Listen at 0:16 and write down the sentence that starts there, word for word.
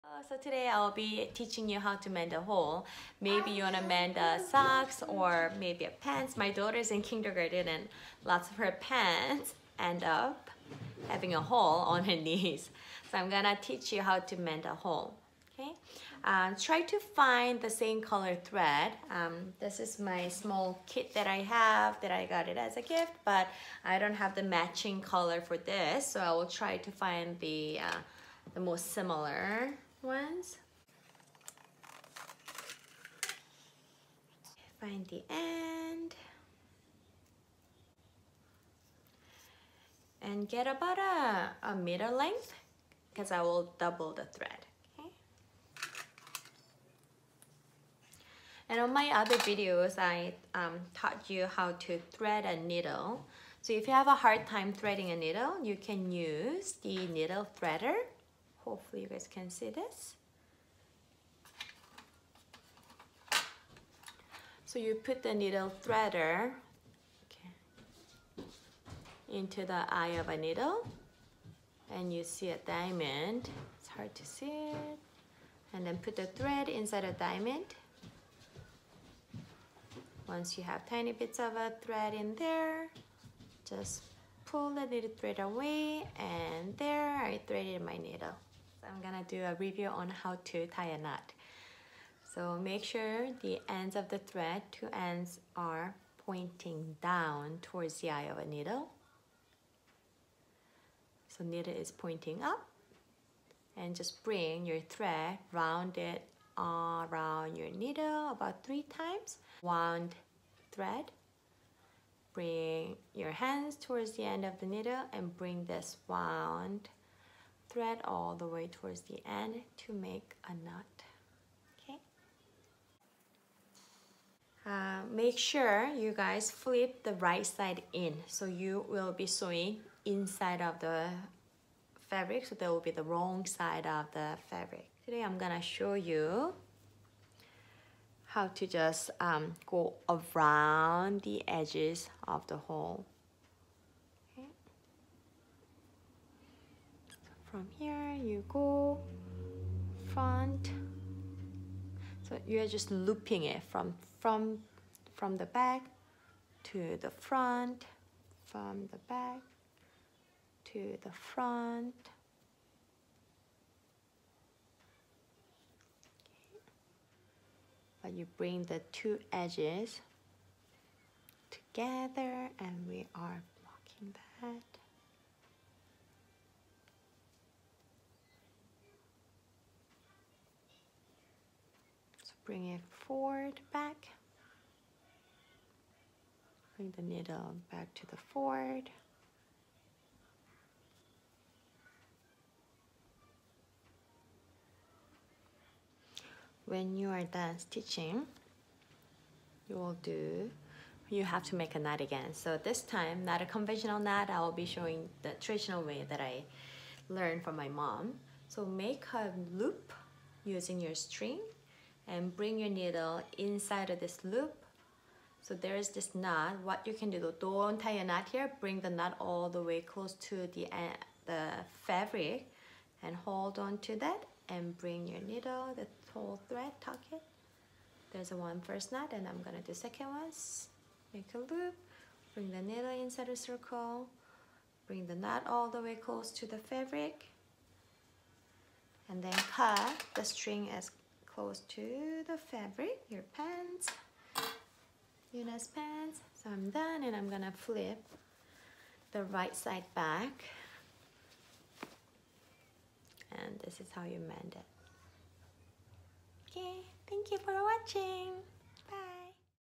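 Uh, try to find the same color thread.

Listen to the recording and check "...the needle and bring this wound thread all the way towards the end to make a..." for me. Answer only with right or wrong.
right.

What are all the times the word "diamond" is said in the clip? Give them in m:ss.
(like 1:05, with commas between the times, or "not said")
1:12, 1:17.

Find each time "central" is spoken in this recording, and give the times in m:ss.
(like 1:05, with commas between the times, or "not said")
not said.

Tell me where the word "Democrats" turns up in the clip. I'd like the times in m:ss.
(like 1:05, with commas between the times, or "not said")
not said.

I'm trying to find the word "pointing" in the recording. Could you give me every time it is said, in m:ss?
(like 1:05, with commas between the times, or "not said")
1:36, 1:41.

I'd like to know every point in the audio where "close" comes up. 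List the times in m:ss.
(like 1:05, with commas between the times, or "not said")
3:39, 3:55, 4:01.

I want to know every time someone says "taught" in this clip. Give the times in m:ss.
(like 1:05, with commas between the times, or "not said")
0:50.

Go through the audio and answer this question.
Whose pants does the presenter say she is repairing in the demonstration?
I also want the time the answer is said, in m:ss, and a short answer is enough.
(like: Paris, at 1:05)
Yuna's, at 4:05.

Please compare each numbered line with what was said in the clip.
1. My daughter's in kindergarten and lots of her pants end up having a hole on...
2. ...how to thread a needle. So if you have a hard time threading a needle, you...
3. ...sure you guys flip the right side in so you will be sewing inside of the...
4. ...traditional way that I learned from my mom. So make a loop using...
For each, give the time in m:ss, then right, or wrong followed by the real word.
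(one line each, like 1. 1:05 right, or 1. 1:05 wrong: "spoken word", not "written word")
1. 0:06 right
2. 0:51 right
3. 2:05 right
4. 3:25 right.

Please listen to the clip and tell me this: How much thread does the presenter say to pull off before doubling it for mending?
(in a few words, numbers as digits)
1 meter.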